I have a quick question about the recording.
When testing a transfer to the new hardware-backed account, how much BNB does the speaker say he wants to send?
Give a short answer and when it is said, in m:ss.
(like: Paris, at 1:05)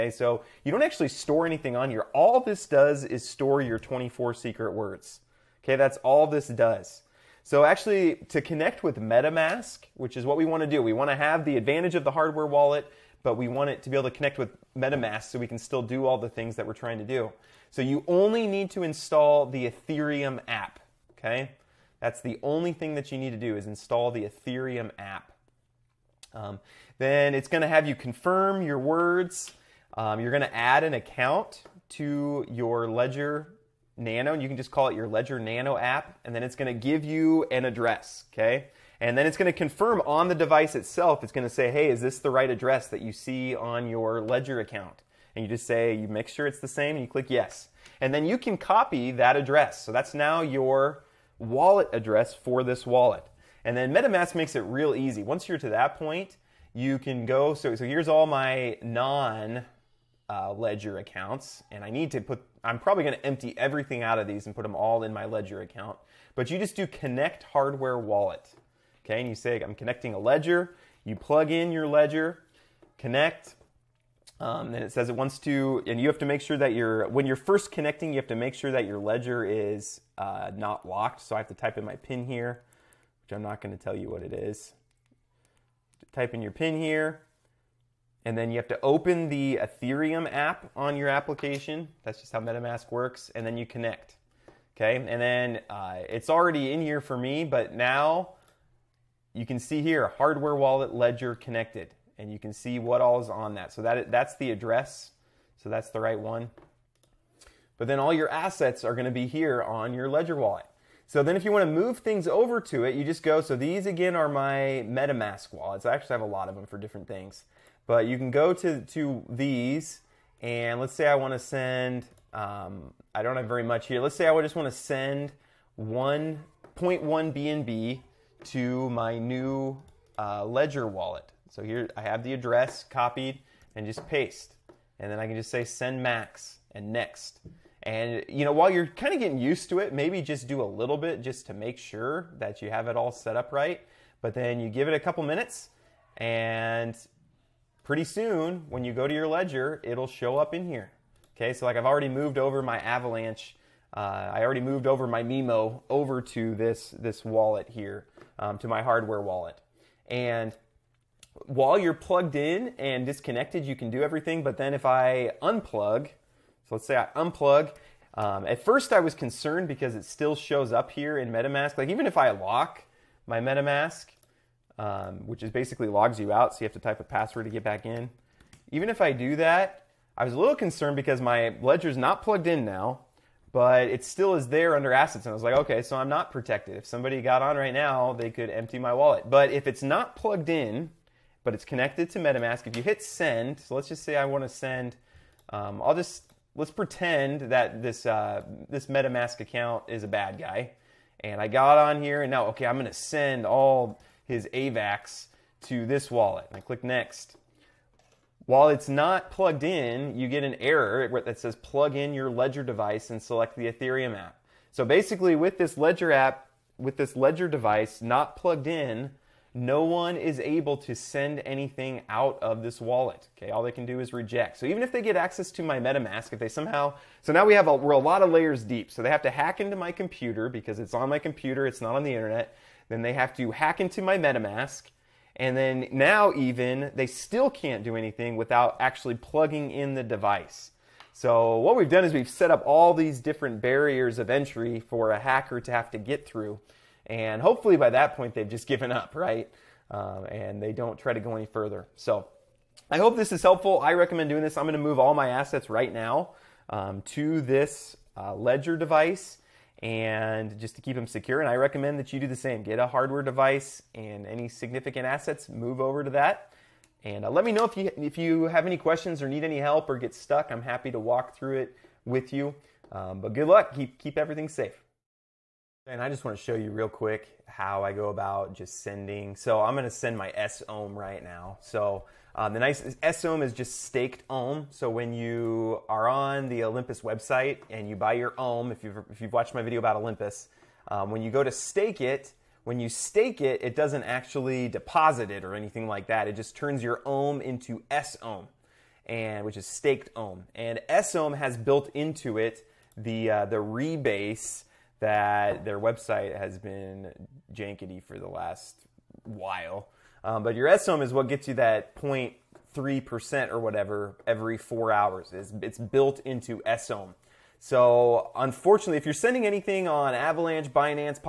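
1.1 BNB, at 2:05.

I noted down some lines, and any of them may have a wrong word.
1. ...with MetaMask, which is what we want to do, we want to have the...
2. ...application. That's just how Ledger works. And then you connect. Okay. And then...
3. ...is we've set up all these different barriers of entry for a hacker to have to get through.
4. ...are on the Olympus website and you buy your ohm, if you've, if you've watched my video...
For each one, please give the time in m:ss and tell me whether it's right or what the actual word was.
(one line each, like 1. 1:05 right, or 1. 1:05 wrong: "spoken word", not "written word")
1. 0:08 right
2. 1:31 wrong: "MetaMask", not "Ledger"
3. 4:02 right
4. 4:45 right.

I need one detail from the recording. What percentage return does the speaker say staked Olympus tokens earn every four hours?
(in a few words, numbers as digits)
0.3%.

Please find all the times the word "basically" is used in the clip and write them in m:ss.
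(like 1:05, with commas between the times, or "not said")
2:55, 3:34.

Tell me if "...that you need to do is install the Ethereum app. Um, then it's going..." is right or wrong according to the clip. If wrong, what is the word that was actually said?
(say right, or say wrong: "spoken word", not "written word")
right.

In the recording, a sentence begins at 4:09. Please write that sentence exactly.
Um, and they don't try to go any further.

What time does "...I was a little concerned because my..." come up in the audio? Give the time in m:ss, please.
3:00.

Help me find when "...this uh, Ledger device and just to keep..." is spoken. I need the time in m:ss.
4:17.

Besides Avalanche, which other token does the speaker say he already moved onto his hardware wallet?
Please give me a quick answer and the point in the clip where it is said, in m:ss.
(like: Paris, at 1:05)
MEMO, at 2:35.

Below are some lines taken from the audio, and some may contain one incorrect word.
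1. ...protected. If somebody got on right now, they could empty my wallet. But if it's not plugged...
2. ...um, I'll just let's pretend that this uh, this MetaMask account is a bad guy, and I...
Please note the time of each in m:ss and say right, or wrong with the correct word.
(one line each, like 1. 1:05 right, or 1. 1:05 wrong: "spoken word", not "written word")
1. 3:06 right
2. 3:15 right.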